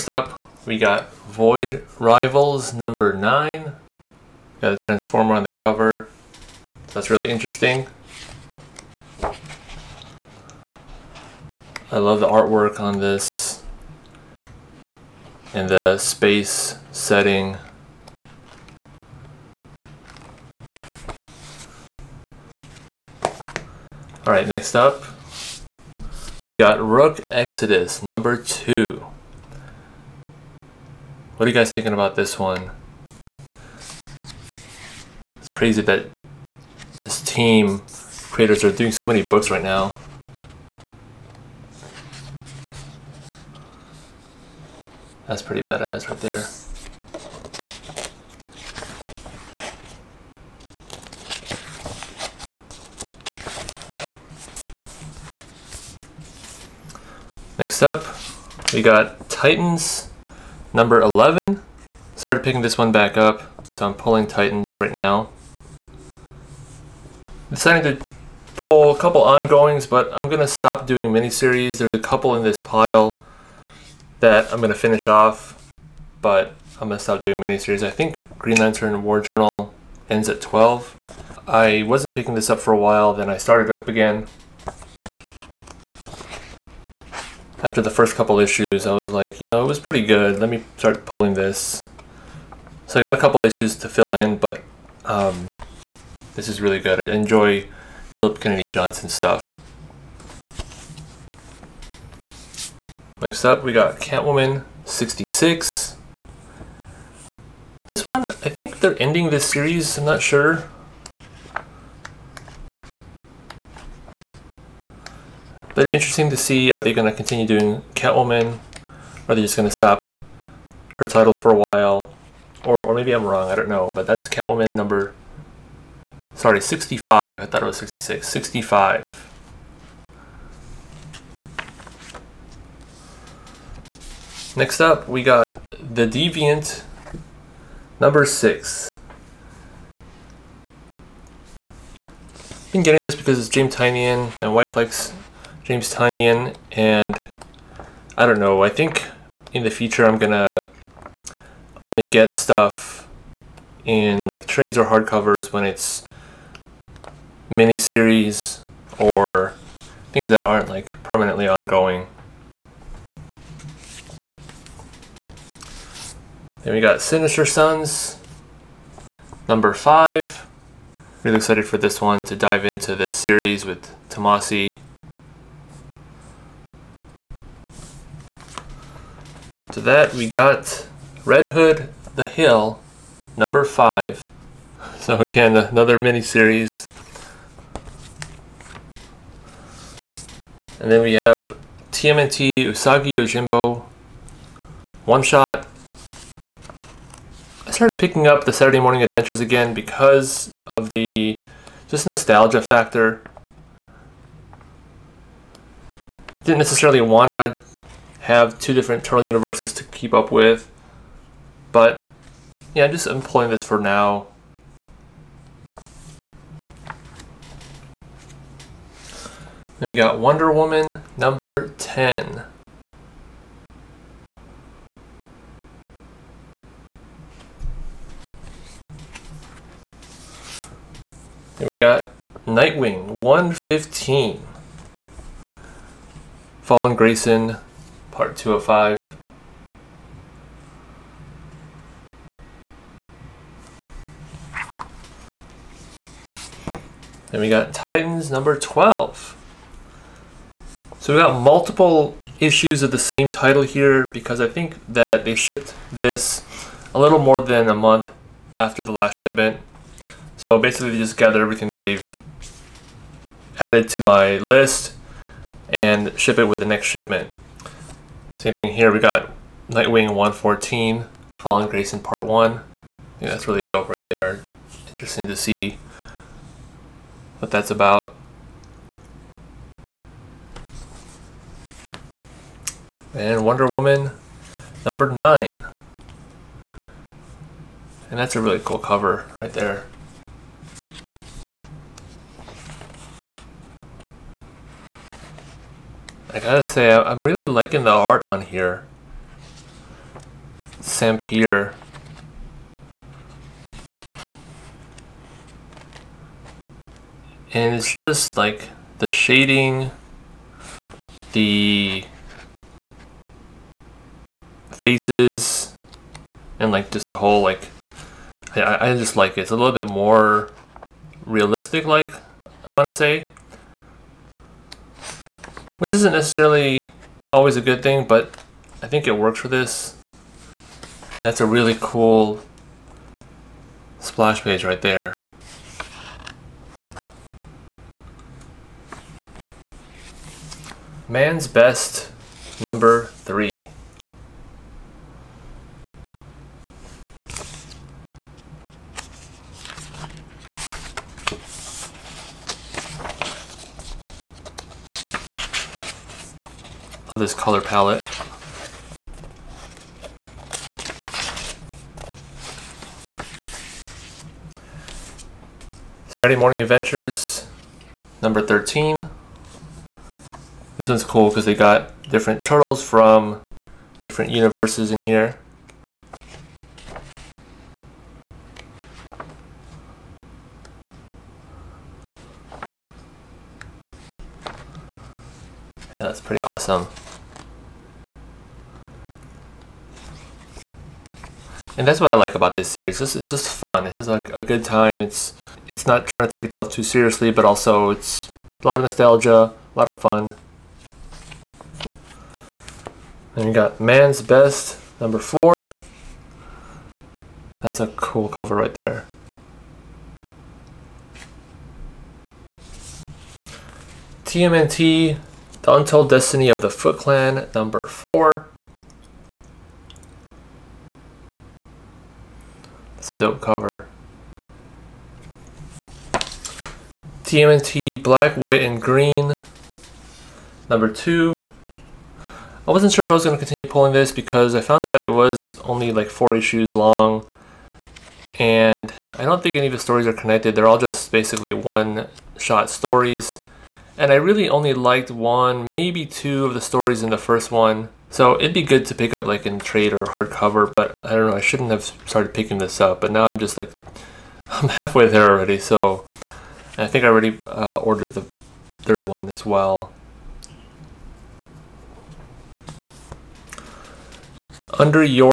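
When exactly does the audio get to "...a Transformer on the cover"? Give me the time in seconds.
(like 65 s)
4 s.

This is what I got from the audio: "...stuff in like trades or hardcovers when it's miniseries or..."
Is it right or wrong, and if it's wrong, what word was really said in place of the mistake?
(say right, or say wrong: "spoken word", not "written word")
right.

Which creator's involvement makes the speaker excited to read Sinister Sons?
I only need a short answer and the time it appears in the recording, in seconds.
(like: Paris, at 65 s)
Tomasi, at 174 s.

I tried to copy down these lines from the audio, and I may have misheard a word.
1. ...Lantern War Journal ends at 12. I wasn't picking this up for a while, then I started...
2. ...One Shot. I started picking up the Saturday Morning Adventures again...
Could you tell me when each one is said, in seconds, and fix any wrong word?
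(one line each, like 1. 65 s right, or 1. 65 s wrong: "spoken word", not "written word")
1. 78 s right
2. 195 s right.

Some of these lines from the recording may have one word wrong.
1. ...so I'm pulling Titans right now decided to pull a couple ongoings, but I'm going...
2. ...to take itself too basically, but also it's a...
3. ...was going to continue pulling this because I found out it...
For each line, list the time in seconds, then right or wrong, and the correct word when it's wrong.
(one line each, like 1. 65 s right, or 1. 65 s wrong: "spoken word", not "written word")
1. 63 s right
2. 396 s wrong: "seriously", not "basically"
3. 433 s right.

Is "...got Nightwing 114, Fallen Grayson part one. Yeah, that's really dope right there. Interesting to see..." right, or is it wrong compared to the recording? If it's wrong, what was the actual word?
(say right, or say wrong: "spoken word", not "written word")
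right.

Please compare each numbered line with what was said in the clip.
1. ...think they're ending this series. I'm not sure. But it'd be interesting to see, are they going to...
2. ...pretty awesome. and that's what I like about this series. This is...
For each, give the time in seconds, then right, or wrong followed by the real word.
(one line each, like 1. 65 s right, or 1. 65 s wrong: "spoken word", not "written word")
1. 108 s right
2. 386 s right.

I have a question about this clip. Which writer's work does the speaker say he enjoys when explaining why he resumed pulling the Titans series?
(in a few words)
Philip Kennedy Johnson.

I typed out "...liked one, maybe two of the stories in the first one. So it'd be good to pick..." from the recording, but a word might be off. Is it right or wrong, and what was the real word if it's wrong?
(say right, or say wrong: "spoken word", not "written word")
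right.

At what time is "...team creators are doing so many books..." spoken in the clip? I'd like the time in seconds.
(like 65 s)
37 s.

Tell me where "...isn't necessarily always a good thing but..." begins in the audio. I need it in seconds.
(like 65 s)
325 s.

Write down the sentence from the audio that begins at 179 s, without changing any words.
To that we got Red Hood, The Hill, number five.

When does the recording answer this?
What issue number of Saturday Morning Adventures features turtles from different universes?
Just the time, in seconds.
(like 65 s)
368 s.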